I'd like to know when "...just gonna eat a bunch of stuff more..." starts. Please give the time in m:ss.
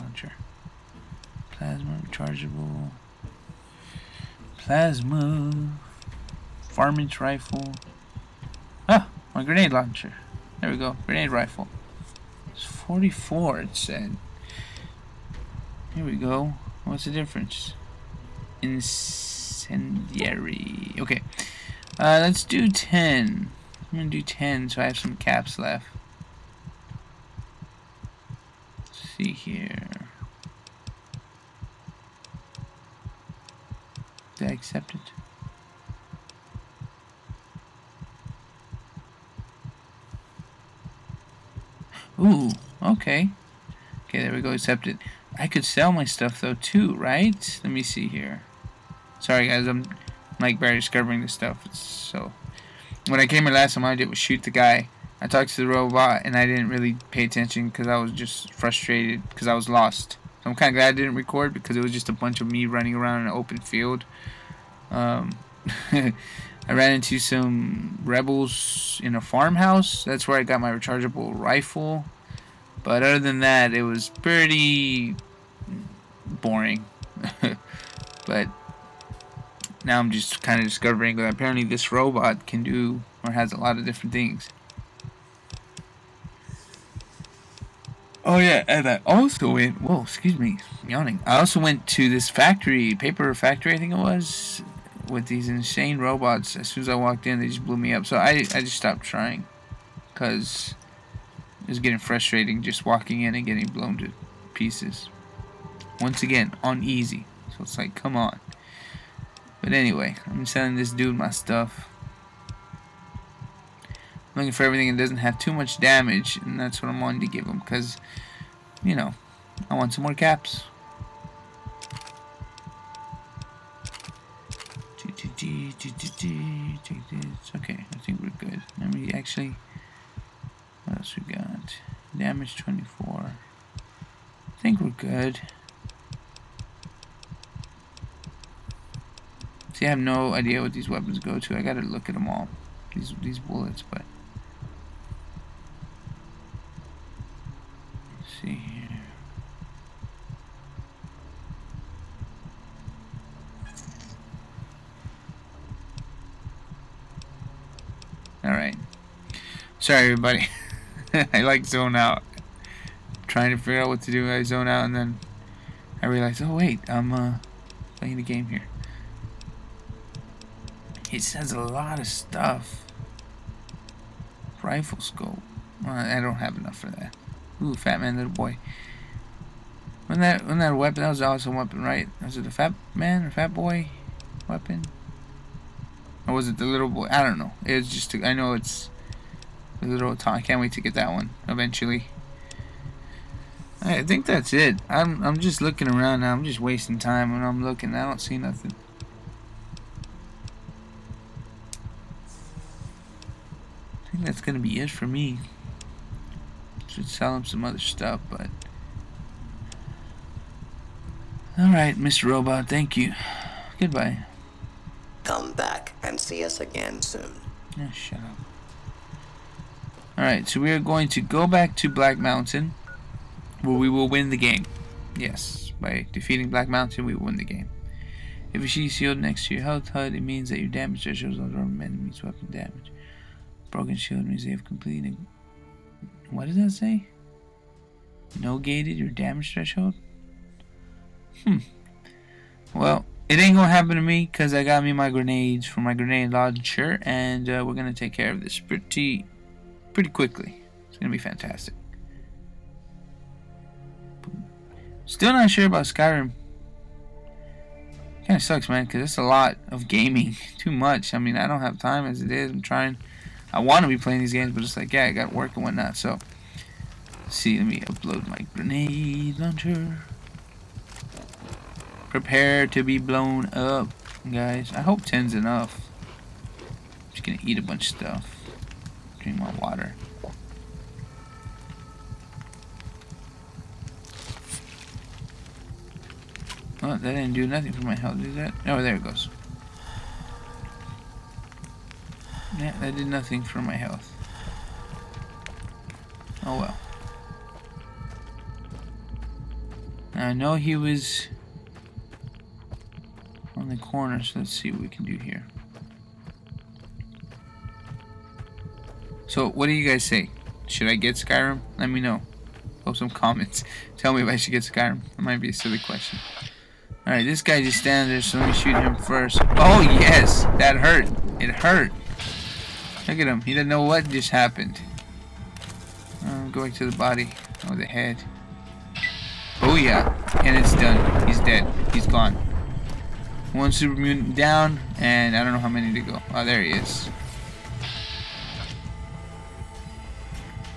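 4:37.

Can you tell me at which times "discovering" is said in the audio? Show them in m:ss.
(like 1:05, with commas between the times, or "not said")
0:50, 1:20.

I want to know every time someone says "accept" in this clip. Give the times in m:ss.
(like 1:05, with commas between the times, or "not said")
0:34, 0:44.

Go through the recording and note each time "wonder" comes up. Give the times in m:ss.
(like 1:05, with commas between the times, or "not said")
not said.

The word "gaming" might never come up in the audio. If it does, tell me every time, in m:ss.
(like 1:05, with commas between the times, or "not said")
4:19.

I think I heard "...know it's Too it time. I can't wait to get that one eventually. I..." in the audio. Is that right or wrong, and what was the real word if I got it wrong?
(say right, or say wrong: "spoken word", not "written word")
wrong: "Little", not "Too".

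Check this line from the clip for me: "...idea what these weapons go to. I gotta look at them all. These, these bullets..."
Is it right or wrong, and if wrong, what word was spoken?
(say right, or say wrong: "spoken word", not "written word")
right.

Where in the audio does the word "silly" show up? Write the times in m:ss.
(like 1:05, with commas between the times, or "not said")
5:15.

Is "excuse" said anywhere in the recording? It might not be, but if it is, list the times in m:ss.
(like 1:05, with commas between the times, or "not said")
1:30.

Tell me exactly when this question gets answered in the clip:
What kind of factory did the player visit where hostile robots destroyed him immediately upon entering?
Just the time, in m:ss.
1:32.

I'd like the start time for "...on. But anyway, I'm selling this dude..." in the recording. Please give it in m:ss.
1:48.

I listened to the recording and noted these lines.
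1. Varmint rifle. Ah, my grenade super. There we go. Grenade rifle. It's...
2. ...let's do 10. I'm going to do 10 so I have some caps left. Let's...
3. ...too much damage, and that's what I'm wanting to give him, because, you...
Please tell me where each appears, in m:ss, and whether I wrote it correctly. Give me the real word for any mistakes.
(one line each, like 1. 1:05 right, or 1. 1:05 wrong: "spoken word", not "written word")
1. 0:06 wrong: "launcher", not "super"
2. 0:22 right
3. 1:55 right.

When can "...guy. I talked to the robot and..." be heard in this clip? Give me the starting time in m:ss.
0:54.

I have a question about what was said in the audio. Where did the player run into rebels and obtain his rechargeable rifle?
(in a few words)
a farmhouse.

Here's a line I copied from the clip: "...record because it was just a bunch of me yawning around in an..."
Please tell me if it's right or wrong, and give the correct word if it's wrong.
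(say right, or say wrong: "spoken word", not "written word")
wrong: "running", not "yawning".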